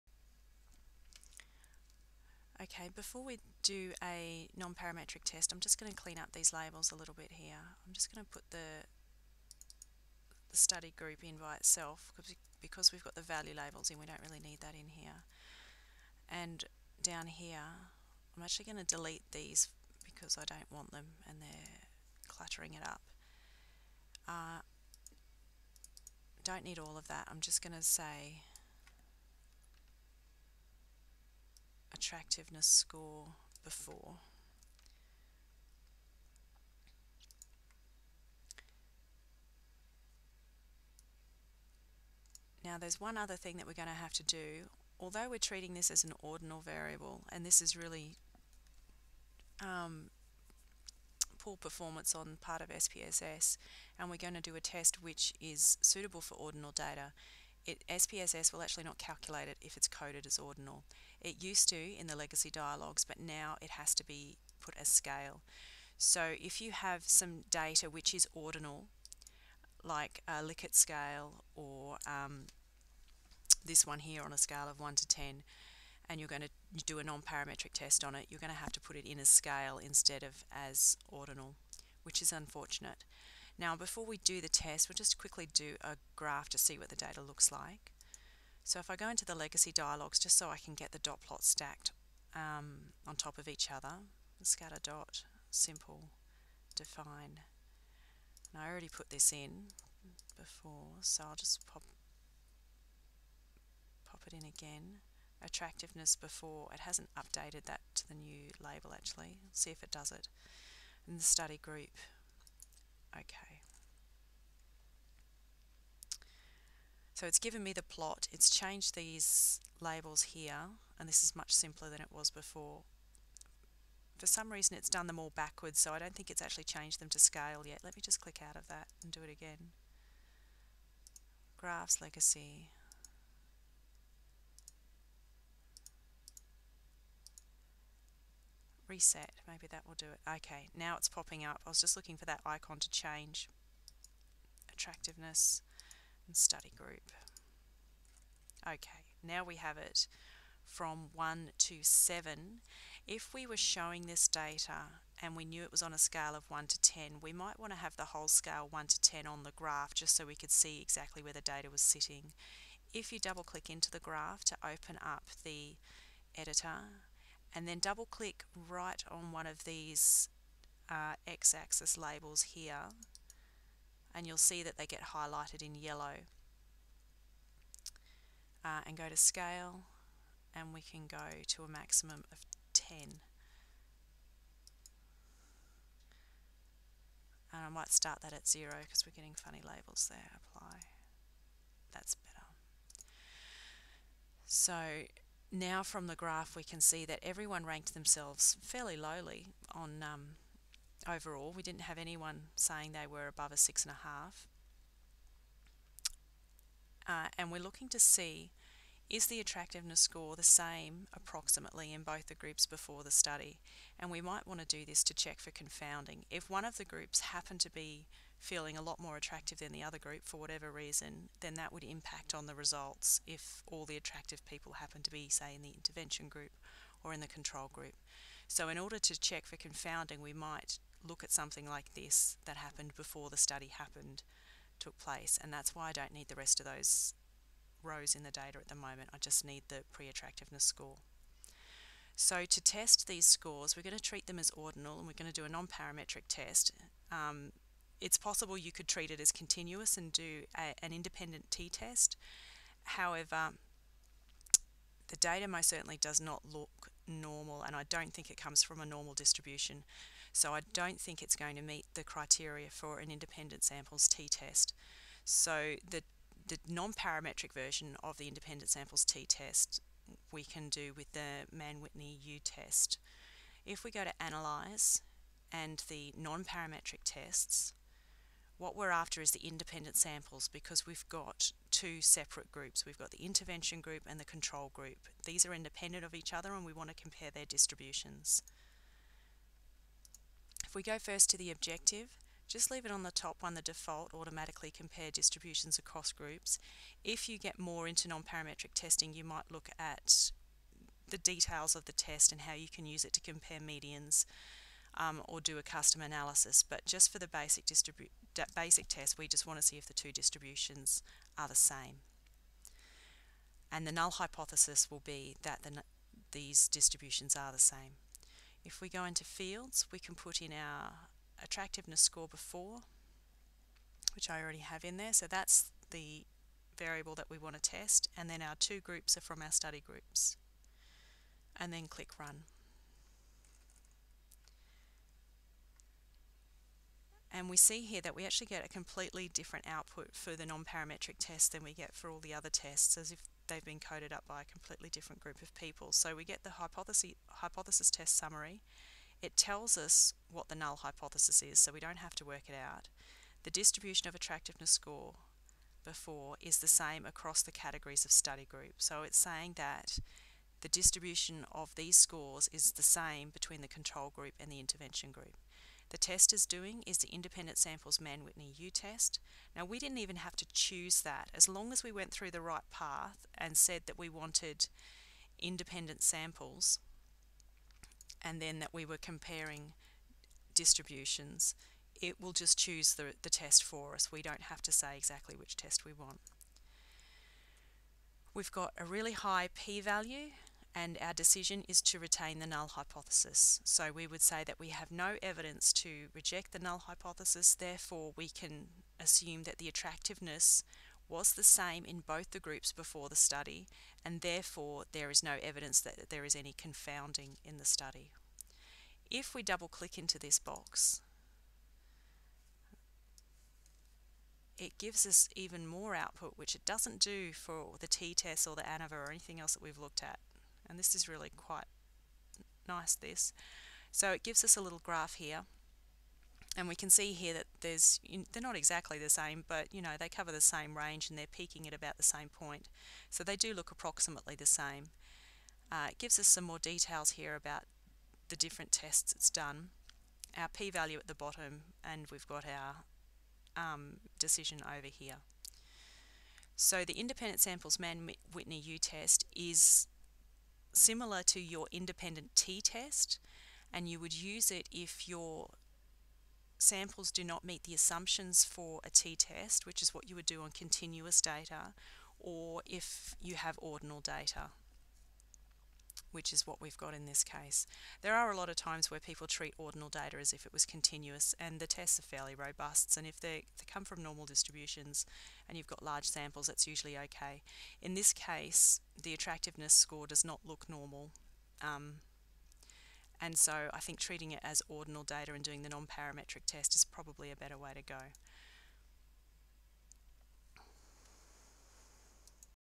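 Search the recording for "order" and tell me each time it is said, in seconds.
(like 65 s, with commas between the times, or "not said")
228 s.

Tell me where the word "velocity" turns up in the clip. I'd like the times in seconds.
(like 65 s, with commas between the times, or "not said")
not said.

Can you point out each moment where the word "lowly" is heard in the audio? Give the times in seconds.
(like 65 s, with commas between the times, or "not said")
198 s.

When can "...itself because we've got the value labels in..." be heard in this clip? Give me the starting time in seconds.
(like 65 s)
11 s.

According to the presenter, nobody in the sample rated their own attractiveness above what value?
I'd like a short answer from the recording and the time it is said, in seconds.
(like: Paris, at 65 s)
6.5, at 203 s.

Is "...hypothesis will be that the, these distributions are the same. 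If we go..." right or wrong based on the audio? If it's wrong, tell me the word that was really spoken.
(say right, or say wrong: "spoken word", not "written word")
right.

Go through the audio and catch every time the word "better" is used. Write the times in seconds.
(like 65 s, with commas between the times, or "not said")
192 s, 487 s.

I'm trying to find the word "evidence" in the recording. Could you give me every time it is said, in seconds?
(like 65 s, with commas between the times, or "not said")
395 s, 405 s.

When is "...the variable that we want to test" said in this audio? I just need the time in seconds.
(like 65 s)
325 s.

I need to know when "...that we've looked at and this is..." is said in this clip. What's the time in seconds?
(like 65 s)
419 s.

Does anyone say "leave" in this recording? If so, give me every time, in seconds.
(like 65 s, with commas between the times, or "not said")
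292 s.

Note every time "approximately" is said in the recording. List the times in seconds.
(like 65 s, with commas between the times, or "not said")
211 s, 433 s.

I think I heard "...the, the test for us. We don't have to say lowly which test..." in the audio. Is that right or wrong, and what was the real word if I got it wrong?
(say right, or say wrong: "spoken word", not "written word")
wrong: "exactly", not "lowly".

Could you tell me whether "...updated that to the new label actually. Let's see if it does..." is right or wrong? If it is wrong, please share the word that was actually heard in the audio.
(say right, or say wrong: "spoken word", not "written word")
right.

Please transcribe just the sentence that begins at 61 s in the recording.
It used to in the legacy dialogues, but now it has to be put as scale.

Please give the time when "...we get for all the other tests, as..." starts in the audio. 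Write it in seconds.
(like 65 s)
341 s.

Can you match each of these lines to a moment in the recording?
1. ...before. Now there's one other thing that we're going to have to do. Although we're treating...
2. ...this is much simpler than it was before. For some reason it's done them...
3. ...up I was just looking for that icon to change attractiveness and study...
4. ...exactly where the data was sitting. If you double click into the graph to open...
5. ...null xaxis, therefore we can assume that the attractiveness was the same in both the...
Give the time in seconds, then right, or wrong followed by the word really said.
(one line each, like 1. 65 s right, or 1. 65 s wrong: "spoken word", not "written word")
1. 33 s right
2. 121 s right
3. 141 s right
4. 160 s right
5. 396 s wrong: "hypothesis", not "xaxis".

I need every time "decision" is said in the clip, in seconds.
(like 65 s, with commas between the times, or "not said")
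391 s, 444 s.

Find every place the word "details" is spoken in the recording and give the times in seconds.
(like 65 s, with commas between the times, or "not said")
301 s, 436 s.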